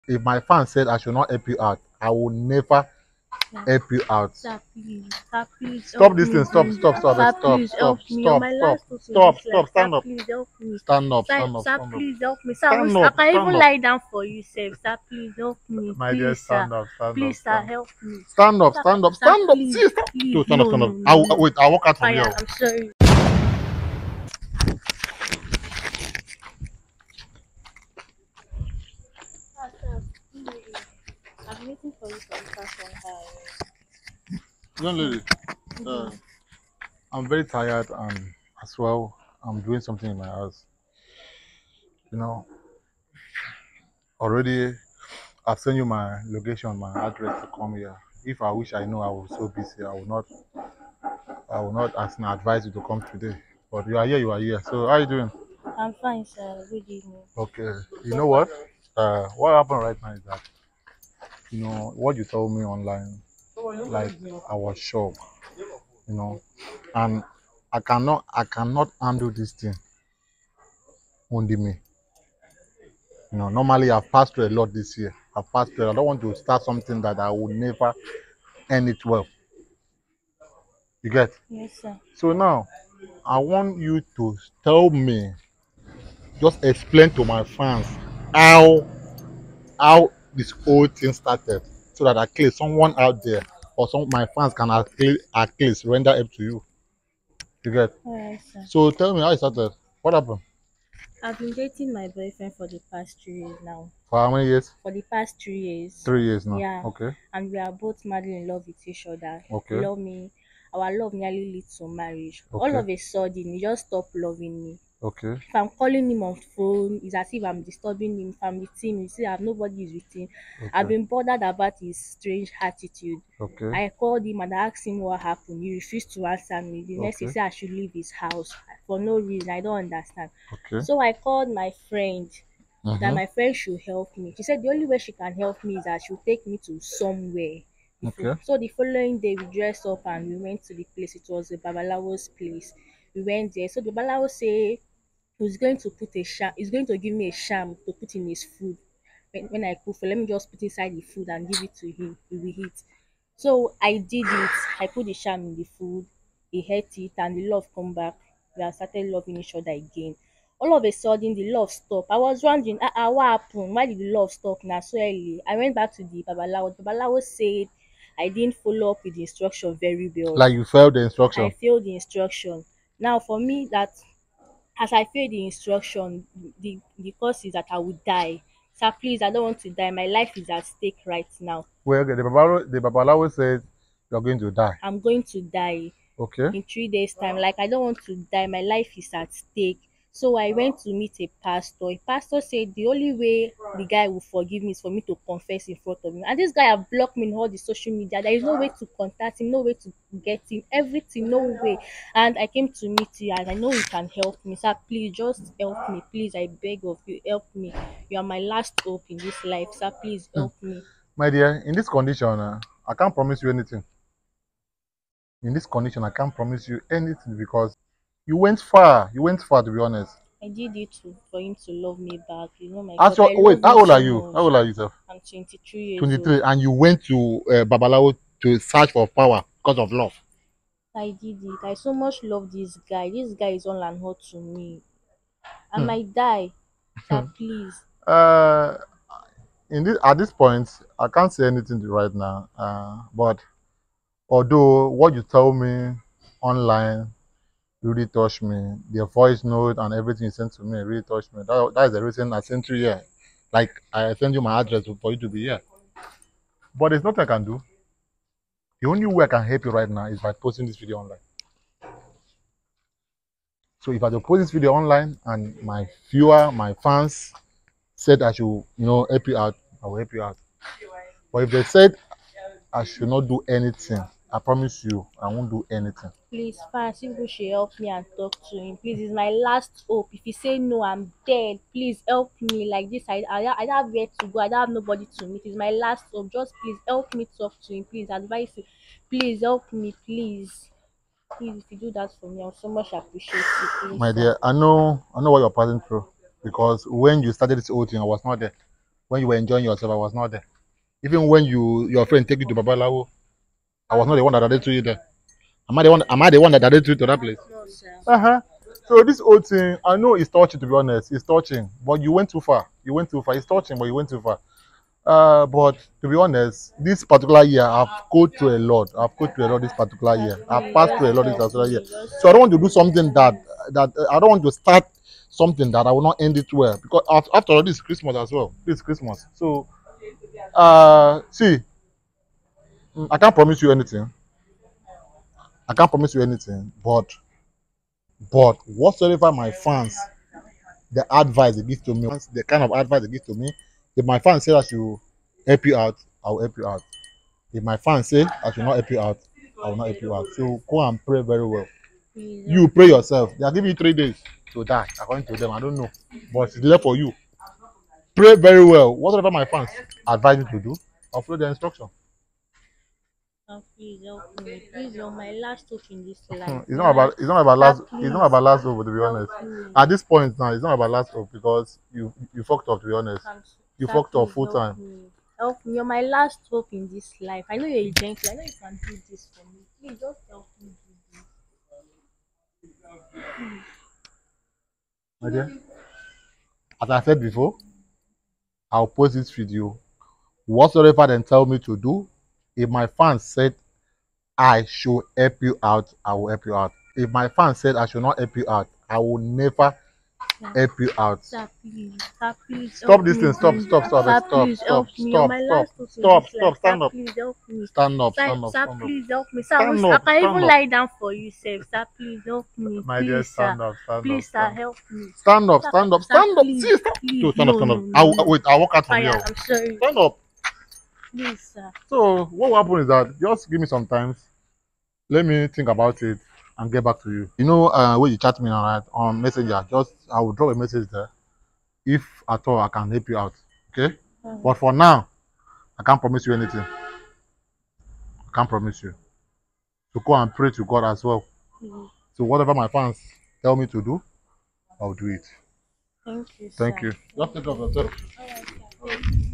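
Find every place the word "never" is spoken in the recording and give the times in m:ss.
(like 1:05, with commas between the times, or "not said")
0:02, 1:17, 6:39.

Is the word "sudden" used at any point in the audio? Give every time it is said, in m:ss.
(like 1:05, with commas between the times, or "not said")
1:52, 2:40.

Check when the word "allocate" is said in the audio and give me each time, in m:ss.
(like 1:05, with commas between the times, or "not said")
not said.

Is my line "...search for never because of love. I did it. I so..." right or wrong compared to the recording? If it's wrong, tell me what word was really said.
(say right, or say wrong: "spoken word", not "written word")
wrong: "power", not "never".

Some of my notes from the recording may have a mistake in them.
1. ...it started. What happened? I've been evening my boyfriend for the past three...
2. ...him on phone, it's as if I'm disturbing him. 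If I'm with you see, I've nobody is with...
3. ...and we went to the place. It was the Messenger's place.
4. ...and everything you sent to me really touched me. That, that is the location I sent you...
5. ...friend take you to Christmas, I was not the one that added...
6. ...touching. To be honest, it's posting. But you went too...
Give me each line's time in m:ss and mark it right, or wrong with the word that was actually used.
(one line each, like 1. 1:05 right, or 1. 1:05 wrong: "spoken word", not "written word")
1. 1:39 wrong: "dating", not "evening"
2. 1:56 right
3. 2:20 wrong: "Babalawo", not "Messenger"
4. 4:09 wrong: "reason", not "location"
5. 5:02 wrong: "Babalawo", not "Christmas"
6. 5:10 wrong: "touching", not "posting".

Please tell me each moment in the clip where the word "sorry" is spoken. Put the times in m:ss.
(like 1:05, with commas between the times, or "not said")
0:22, 6:59.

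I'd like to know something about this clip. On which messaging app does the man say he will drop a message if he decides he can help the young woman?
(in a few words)
Messenger.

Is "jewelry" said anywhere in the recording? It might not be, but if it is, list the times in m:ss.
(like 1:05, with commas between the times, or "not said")
not said.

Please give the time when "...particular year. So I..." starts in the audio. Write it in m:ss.
5:21.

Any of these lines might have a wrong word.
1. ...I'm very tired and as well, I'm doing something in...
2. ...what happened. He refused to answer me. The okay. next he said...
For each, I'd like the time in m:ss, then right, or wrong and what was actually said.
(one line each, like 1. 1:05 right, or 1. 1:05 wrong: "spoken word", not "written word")
1. 0:37 right
2. 2:04 right.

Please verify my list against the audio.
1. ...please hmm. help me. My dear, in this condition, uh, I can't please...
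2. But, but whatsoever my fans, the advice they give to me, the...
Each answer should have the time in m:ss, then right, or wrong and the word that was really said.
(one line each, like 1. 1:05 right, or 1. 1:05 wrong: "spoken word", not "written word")
1. 3:30 wrong: "promise", not "please"
2. 5:36 right.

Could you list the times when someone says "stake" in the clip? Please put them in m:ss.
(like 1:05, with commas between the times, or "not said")
3:00, 3:09.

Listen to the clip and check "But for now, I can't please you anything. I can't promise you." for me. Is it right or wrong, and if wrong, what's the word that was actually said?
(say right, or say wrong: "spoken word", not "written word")
wrong: "promise", not "please".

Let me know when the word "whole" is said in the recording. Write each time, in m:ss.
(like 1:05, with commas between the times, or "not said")
1:30, 4:57, 5:09.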